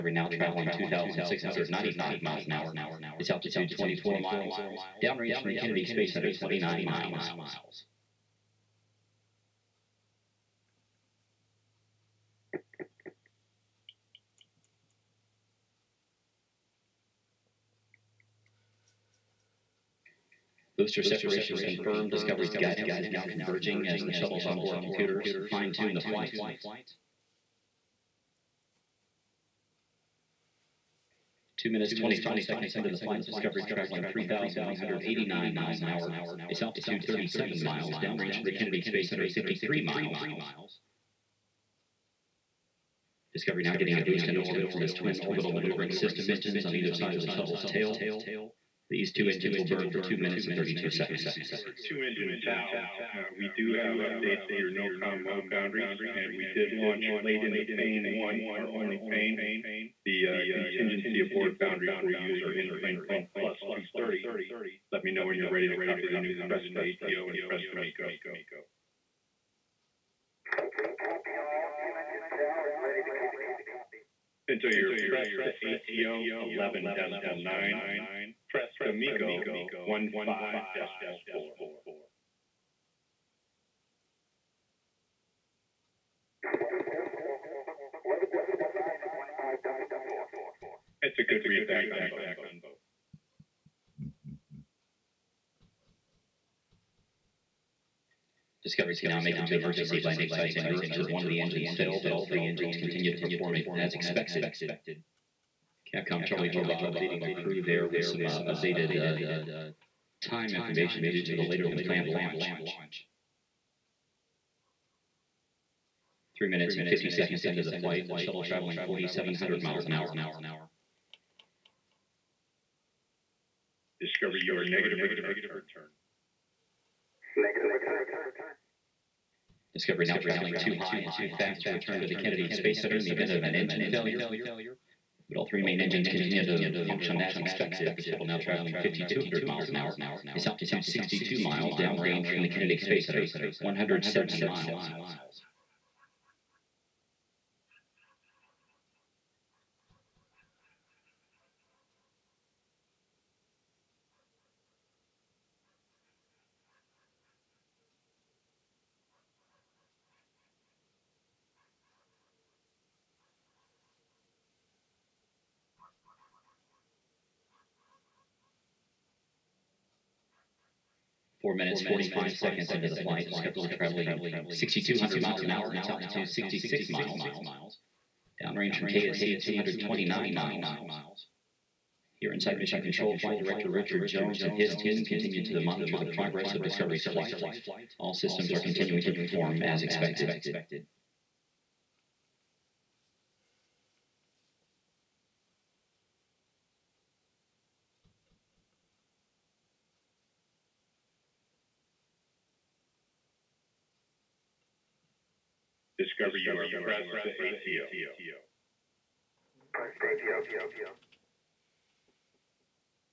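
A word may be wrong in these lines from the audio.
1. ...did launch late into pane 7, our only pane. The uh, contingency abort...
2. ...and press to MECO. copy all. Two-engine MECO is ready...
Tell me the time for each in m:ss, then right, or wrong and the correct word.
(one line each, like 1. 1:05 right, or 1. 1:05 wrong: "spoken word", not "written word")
1. 0:56 wrong: "1", not "7"
2. 1:07 wrong: "Tau", not "MECO".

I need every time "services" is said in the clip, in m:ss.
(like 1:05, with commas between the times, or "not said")
not said.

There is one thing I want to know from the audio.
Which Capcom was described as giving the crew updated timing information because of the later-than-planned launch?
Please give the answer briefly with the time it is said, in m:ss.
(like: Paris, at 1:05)
Charlie Hobaugh, at 1:46.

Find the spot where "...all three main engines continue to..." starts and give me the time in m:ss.
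2:15.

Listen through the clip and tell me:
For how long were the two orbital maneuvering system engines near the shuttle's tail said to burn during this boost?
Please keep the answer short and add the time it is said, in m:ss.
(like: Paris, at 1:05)
2 minutes and 32 seconds, at 0:49.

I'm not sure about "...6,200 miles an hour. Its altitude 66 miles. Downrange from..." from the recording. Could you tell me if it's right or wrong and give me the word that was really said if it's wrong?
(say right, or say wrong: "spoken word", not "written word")
right.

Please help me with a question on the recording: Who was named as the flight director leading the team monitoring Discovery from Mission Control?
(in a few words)
Richard Jones.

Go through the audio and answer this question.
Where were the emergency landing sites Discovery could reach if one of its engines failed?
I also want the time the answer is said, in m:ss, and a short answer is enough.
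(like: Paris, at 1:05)
Europe, at 1:40.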